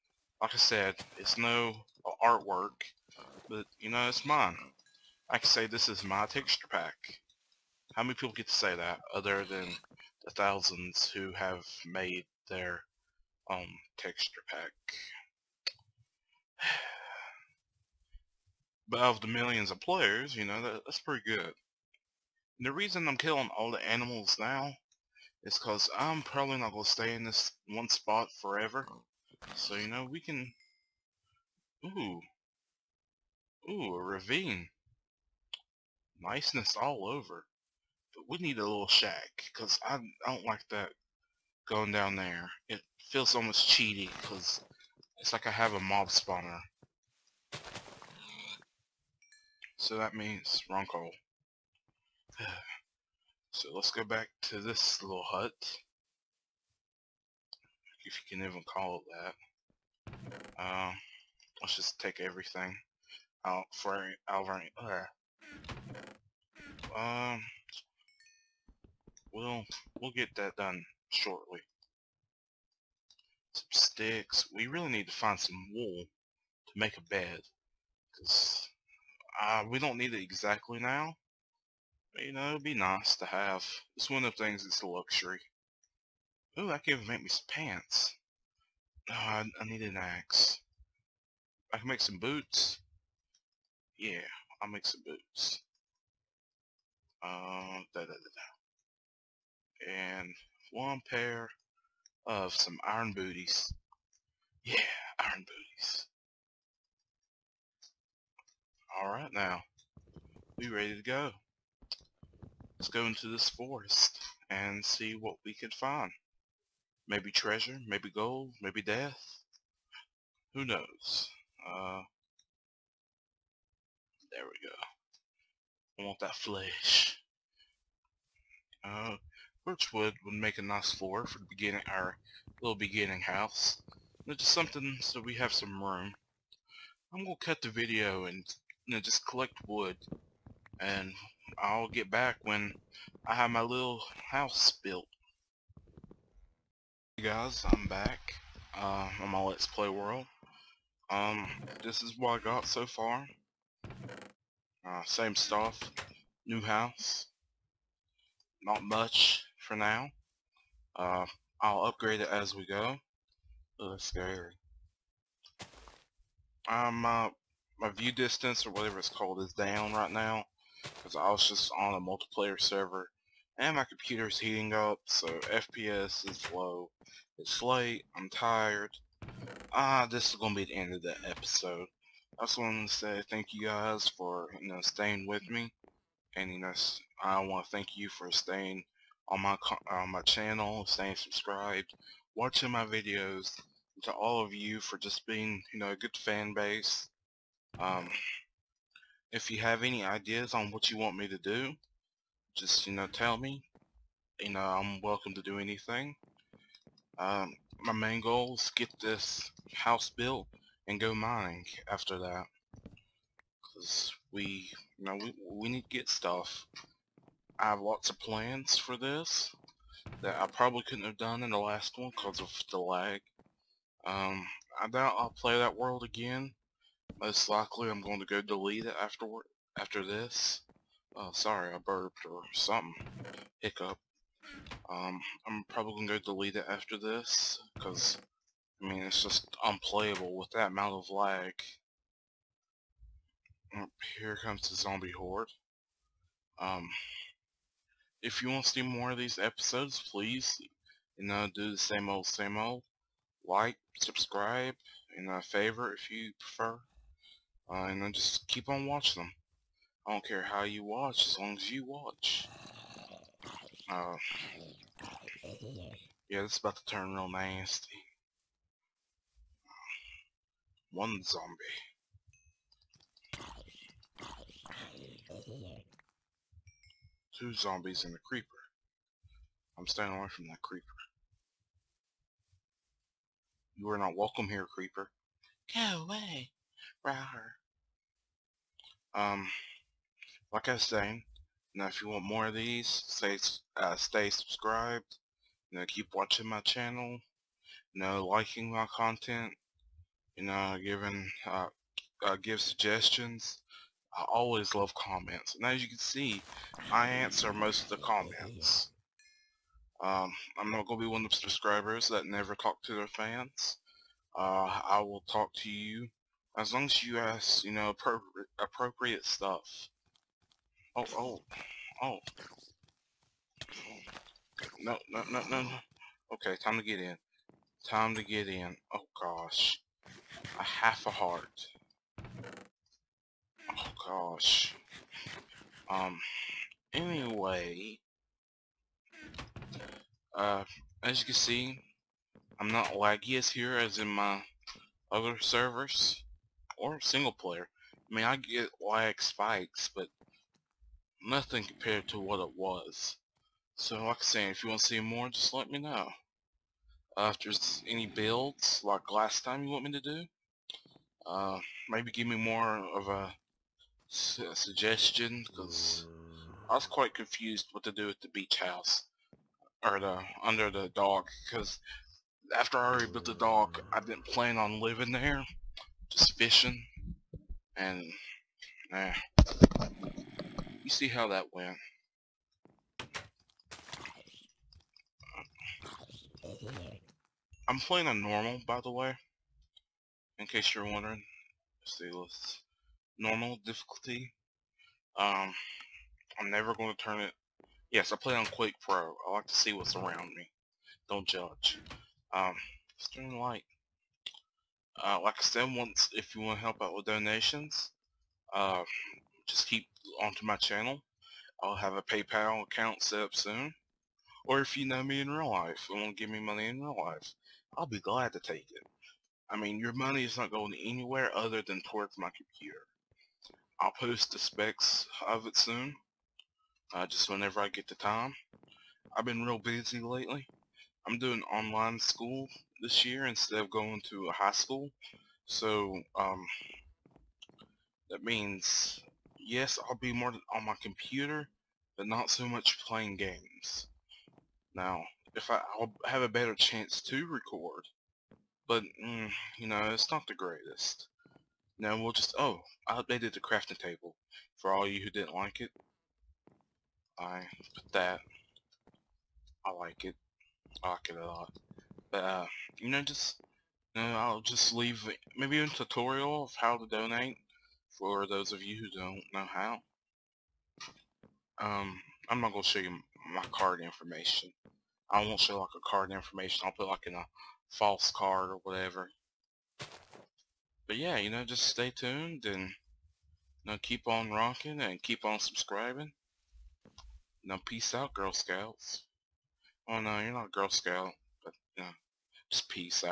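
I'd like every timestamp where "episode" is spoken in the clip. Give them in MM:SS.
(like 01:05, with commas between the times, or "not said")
03:01, 04:09.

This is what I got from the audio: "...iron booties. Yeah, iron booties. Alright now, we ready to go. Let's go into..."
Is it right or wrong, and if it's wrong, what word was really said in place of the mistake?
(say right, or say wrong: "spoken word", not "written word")
right.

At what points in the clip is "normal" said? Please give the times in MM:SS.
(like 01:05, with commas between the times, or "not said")
06:28, 06:33.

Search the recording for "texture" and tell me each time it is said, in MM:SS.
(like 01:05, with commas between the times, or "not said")
00:06, 00:13.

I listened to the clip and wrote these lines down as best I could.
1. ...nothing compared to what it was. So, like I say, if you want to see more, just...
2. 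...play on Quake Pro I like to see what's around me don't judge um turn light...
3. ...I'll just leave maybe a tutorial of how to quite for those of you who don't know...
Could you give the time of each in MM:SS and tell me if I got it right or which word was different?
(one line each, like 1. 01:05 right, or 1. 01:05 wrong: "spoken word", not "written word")
1. 05:51 right
2. 06:38 right
3. 07:44 wrong: "donate", not "quite".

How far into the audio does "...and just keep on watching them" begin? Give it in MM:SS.
04:17.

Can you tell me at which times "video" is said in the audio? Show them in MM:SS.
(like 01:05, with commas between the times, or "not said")
02:17, 03:12.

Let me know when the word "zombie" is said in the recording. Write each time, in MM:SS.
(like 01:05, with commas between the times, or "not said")
04:04, 04:31, 04:37.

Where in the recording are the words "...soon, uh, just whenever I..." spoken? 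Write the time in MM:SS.
07:05.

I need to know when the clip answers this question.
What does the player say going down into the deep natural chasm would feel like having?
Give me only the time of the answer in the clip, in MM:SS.
00:45.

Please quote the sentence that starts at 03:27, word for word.
Um, my main goal is get this house built and go mining after that.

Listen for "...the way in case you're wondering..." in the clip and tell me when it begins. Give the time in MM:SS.
06:28.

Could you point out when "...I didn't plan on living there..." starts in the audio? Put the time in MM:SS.
06:13.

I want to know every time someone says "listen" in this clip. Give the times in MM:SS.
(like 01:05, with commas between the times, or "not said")
not said.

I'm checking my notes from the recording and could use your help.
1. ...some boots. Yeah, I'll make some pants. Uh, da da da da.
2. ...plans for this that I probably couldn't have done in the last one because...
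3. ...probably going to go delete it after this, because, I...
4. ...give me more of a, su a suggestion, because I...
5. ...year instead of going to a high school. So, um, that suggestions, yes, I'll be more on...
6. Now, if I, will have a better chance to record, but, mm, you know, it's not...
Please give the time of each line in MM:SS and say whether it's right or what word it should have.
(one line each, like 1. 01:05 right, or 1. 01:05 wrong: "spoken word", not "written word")
1. 01:32 wrong: "boots", not "pants"
2. 03:38 right
3. 03:55 right
4. 06:02 right
5. 07:13 wrong: "means", not "suggestions"
6. 07:24 right.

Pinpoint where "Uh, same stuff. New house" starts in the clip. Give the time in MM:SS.
02:33.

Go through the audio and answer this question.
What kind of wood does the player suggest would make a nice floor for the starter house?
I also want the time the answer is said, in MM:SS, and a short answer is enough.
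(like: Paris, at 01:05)
birchwood, at 02:09.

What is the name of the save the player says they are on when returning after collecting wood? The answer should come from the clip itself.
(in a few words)
Let's Play World.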